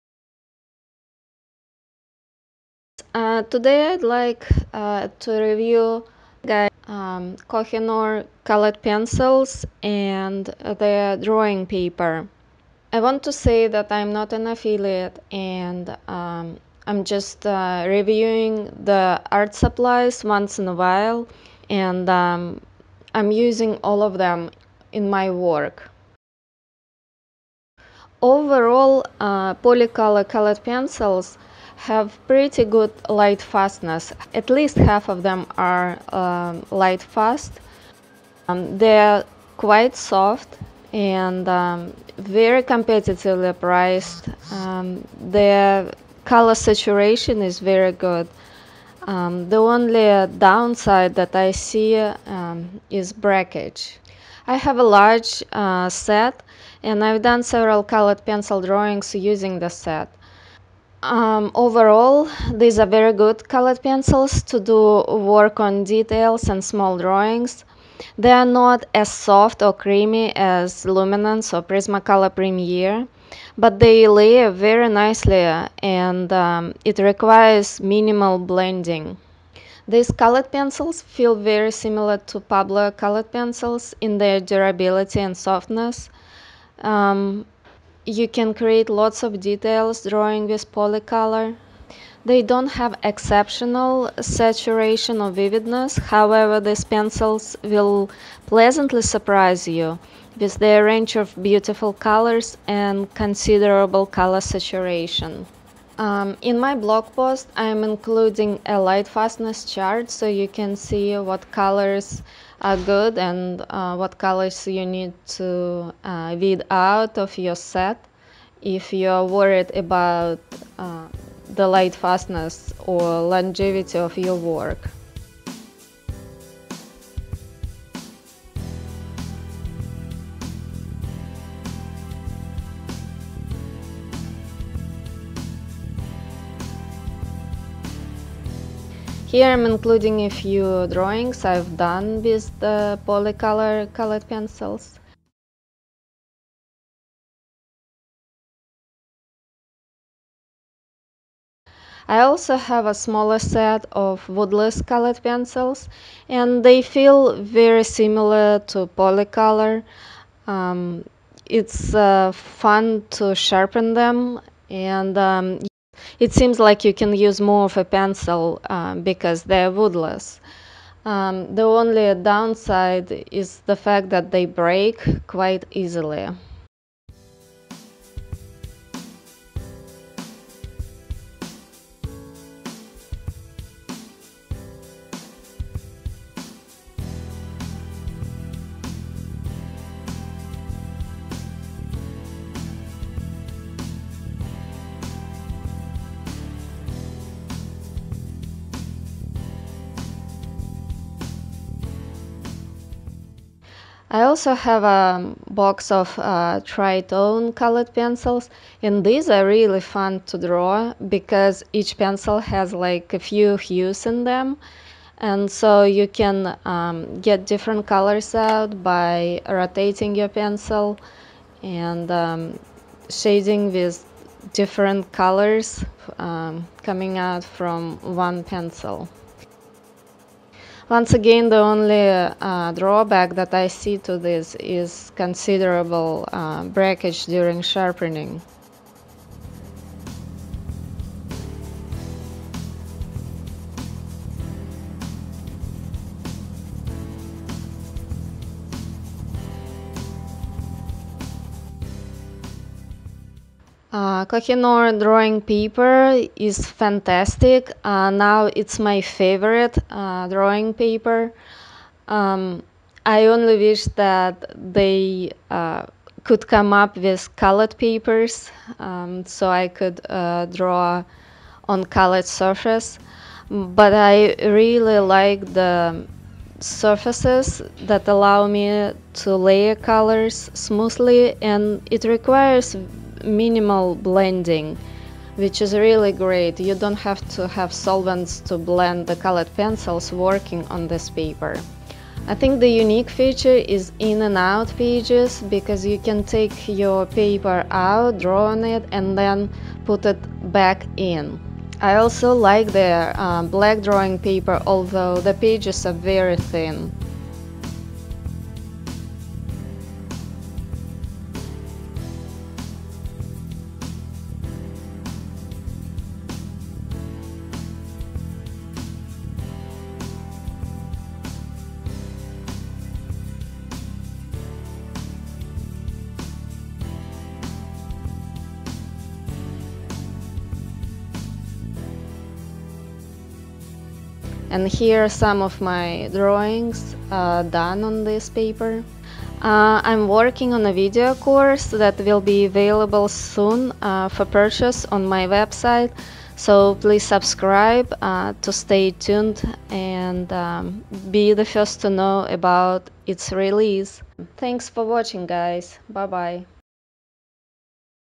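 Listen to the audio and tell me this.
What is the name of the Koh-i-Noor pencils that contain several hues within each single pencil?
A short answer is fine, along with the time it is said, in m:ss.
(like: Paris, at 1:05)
Tritone, at 3:26.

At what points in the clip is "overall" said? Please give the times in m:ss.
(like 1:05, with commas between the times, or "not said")
0:28, 1:01.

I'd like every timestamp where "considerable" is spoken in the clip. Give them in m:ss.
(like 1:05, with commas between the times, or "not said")
1:43, 3:55.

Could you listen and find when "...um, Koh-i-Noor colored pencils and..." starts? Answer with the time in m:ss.
0:06.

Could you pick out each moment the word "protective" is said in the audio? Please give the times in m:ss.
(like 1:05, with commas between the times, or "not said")
not said.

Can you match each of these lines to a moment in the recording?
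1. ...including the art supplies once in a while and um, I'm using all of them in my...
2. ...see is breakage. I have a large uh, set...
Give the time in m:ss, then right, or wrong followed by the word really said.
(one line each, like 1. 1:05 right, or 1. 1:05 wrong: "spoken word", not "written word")
1. 0:17 wrong: "reviewing", not "including"
2. 0:51 right.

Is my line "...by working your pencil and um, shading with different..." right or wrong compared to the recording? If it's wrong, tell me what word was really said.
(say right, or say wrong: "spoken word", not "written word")
wrong: "rotating", not "working".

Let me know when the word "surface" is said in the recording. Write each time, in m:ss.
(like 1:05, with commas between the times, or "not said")
4:32, 4:36.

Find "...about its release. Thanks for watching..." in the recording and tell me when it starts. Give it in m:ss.
5:52.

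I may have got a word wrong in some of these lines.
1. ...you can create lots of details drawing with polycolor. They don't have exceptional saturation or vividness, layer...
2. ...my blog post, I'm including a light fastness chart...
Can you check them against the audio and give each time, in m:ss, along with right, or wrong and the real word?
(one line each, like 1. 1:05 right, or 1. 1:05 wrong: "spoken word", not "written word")
1. 1:28 wrong: "however", not "layer"
2. 1:46 right.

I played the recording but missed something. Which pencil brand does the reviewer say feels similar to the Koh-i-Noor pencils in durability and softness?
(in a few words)
Pablo.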